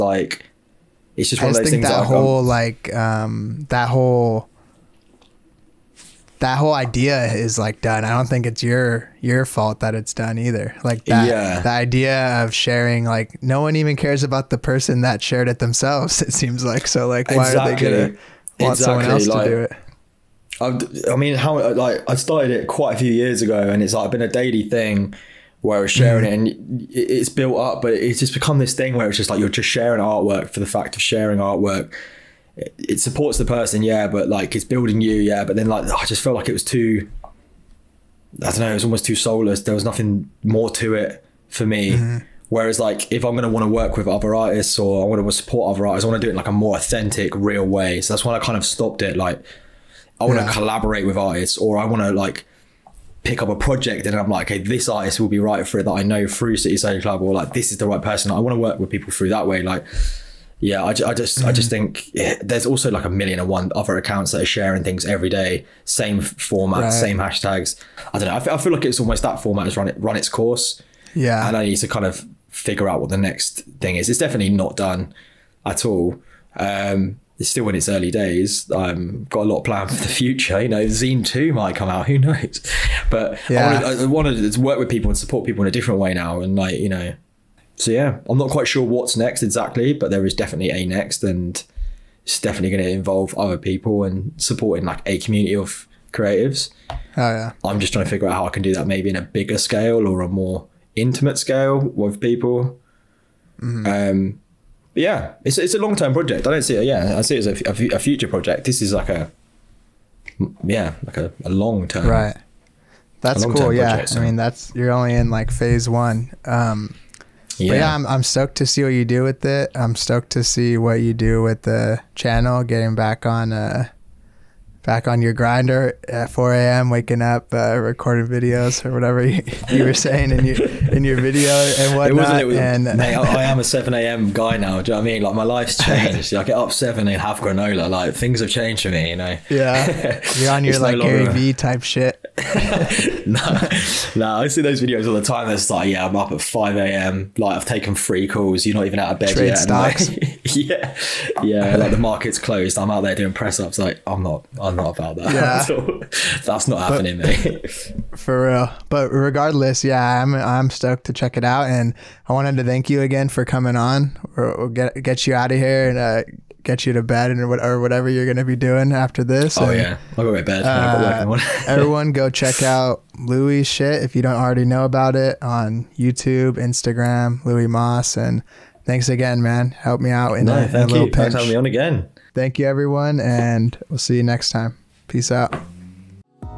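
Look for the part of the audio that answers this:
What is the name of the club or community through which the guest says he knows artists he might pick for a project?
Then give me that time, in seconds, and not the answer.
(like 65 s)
56 s.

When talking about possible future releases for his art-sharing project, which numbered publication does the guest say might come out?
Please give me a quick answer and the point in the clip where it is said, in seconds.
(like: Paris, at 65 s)
Zine 2, at 80 s.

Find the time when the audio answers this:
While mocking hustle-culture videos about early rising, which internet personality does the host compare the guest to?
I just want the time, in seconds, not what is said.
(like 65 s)
141 s.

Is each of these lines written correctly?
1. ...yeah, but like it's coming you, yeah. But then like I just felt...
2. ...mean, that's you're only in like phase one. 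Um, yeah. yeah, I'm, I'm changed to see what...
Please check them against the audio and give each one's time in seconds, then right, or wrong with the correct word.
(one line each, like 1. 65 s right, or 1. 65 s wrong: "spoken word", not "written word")
1. 33 s wrong: "building", not "coming"
2. 114 s wrong: "stoked", not "changed".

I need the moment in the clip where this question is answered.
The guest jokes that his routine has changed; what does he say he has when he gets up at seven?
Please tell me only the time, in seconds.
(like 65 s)
137 s.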